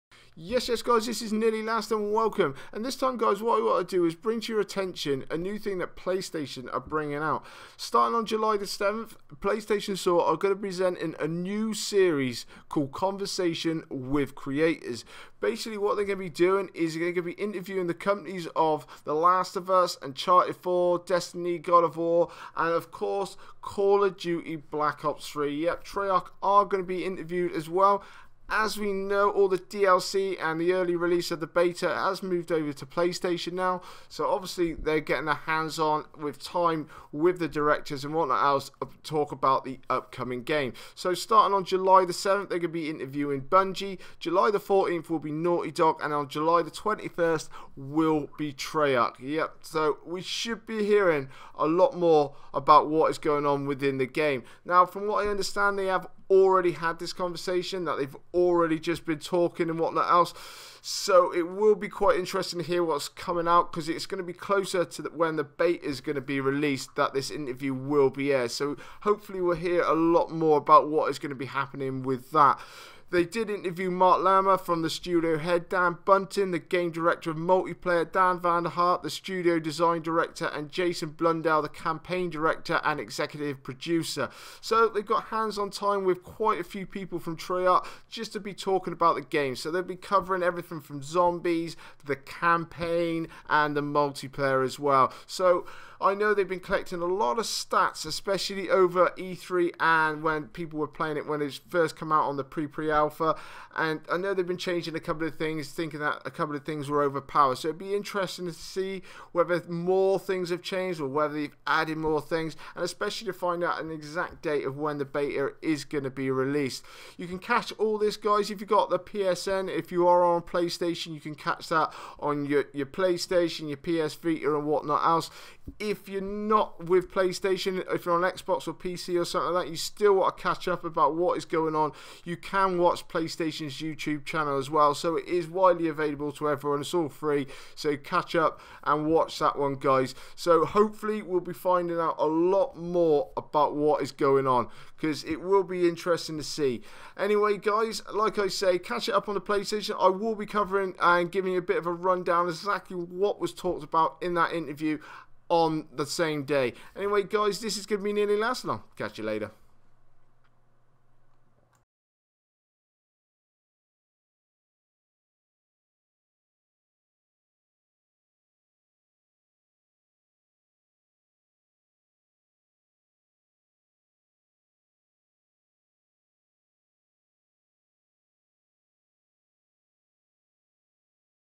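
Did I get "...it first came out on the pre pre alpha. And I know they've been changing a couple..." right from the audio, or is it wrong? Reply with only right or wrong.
right.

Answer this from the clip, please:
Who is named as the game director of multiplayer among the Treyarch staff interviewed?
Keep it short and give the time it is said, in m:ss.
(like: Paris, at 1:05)
Dan Bunting, at 1:15.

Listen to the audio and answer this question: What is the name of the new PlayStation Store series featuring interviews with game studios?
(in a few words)
Conversation with Creators.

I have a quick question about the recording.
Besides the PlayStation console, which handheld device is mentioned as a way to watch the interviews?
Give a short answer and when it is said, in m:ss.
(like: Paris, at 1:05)
PS Vita, at 2:03.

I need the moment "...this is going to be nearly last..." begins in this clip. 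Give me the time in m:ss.
2:37.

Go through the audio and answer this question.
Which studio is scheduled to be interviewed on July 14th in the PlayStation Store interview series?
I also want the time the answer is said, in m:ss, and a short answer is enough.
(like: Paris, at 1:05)
Naughty Dog, at 0:45.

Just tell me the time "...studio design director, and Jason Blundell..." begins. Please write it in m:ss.
1:19.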